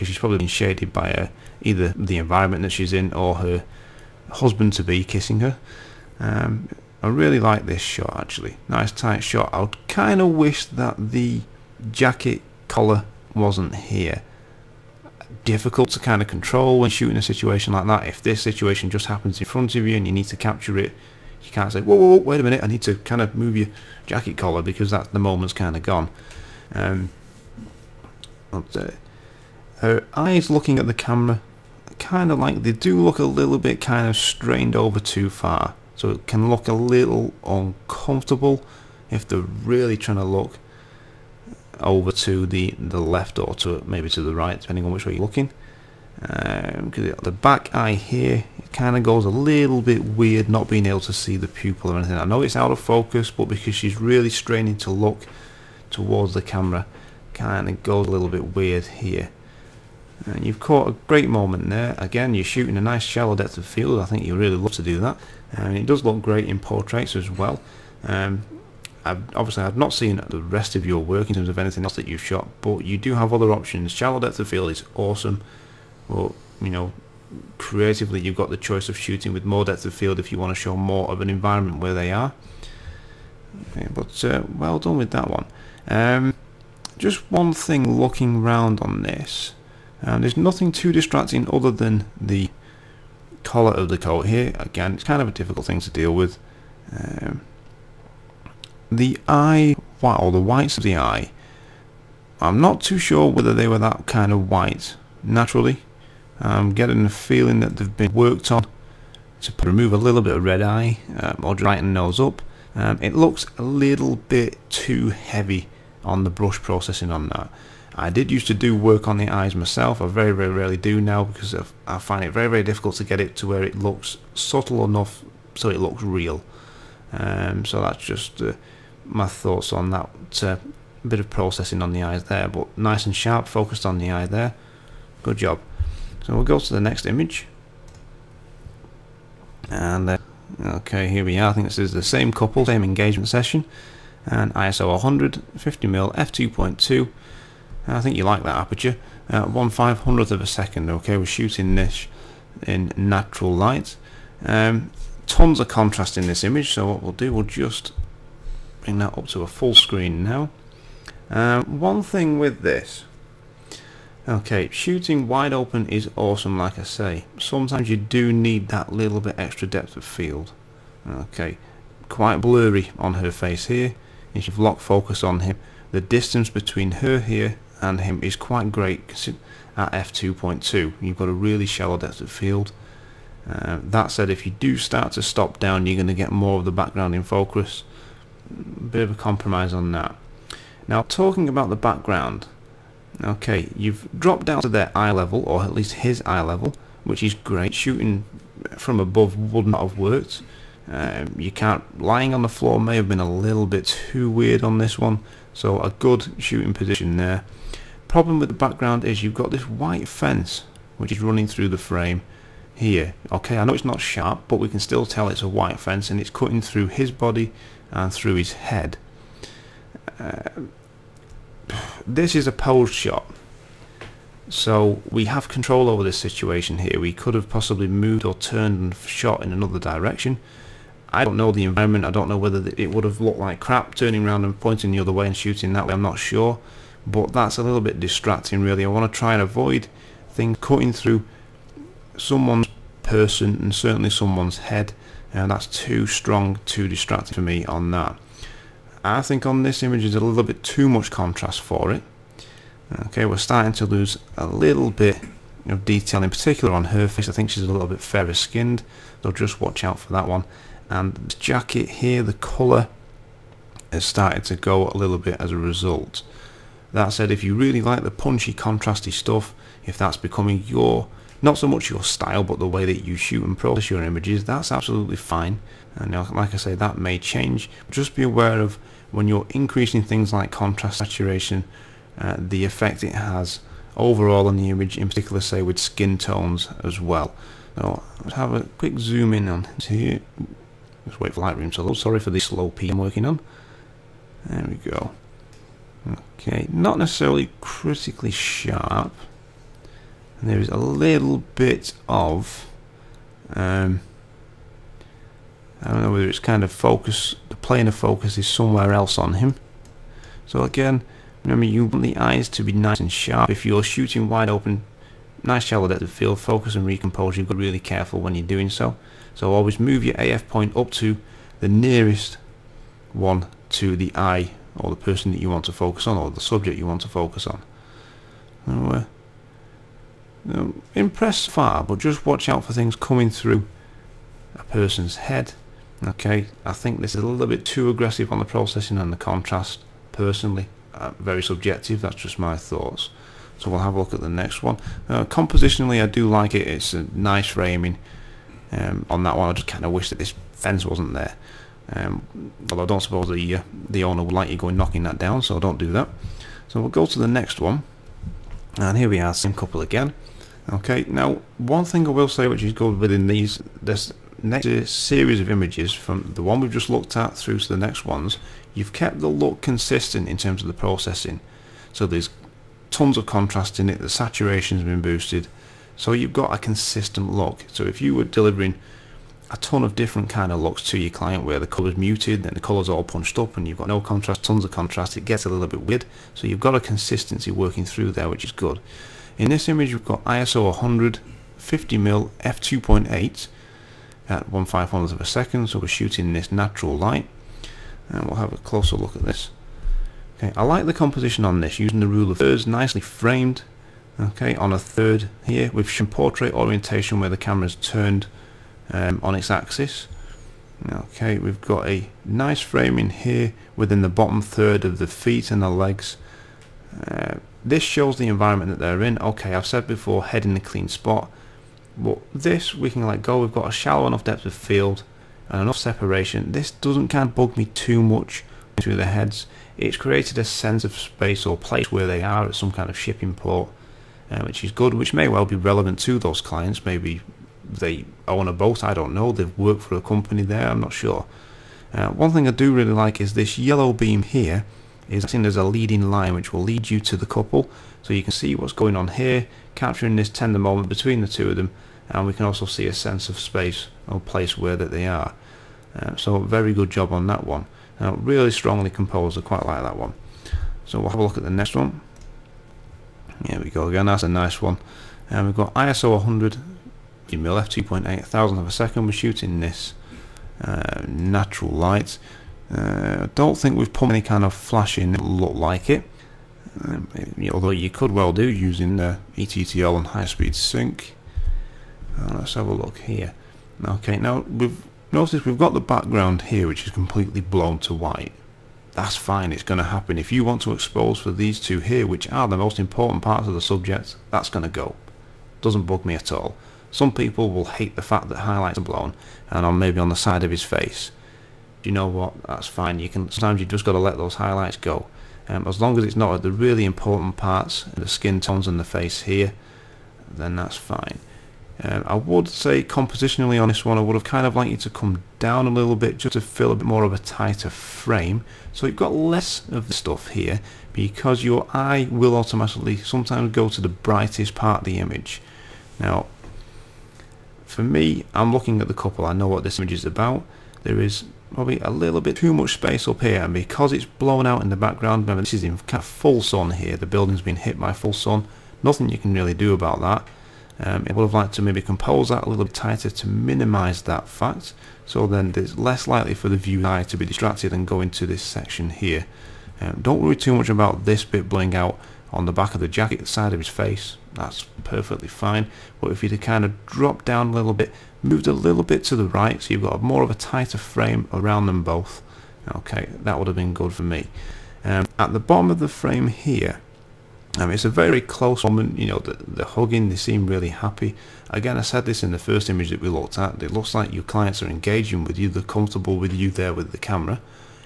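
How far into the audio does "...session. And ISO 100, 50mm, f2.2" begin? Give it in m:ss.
2:23.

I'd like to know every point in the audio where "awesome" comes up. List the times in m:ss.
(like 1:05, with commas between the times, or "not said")
1:14, 2:46.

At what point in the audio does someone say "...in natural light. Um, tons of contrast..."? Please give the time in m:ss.
2:32.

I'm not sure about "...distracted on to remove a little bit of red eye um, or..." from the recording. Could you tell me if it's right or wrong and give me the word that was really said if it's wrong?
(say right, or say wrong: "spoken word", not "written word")
wrong: "worked", not "distracted".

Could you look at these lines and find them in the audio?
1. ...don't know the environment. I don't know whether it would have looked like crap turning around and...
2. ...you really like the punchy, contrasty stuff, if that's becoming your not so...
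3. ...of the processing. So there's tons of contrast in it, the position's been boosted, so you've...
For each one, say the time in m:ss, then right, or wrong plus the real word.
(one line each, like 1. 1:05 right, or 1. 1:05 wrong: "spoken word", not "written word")
1. 3:51 right
2. 4:27 right
3. 6:10 wrong: "saturation", not "position".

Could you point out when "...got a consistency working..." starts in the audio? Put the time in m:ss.
6:26.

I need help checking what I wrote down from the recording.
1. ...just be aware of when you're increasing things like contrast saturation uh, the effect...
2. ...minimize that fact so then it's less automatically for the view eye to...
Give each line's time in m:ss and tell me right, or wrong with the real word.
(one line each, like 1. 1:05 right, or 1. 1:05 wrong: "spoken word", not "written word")
1. 4:37 right
2. 9:03 wrong: "likely", not "automatically".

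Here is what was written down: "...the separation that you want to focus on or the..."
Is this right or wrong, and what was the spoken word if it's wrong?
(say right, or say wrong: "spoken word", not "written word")
wrong: "person", not "separation".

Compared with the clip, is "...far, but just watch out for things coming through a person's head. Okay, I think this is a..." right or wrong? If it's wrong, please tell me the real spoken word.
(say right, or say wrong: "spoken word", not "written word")
right.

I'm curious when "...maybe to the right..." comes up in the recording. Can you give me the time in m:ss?
0:43.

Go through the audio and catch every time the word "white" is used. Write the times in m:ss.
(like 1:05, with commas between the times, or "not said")
1:40, 1:44, 3:29, 3:35, 8:07.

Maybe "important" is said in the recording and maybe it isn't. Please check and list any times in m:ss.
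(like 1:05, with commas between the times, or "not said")
8:12, 8:26.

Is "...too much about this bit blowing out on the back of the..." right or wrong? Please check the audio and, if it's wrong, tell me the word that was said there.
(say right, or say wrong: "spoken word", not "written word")
right.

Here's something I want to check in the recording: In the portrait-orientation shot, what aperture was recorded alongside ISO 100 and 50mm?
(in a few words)
f2.8.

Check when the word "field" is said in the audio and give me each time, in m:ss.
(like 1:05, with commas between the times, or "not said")
1:03, 1:14, 1:19, 2:50, 3:02, 5:16, 7:04.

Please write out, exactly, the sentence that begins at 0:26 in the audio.
Um, her eyes looking at the camera, kind of like they do look a little bit kind of strained over too far.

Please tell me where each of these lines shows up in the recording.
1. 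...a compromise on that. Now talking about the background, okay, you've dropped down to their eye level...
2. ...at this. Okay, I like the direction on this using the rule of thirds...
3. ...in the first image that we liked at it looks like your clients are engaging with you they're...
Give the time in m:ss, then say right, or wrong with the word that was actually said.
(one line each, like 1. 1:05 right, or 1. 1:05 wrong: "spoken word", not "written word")
1. 3:09 right
2. 6:39 wrong: "composition", not "direction"
3. 9:32 wrong: "looked", not "liked".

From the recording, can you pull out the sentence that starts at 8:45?
Now, for me, I'm looking at the couple.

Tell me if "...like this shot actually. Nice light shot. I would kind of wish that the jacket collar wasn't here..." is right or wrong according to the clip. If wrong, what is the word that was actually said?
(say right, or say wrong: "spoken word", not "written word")
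wrong: "tight", not "light".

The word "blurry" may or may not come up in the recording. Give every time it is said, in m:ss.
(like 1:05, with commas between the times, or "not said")
2:52.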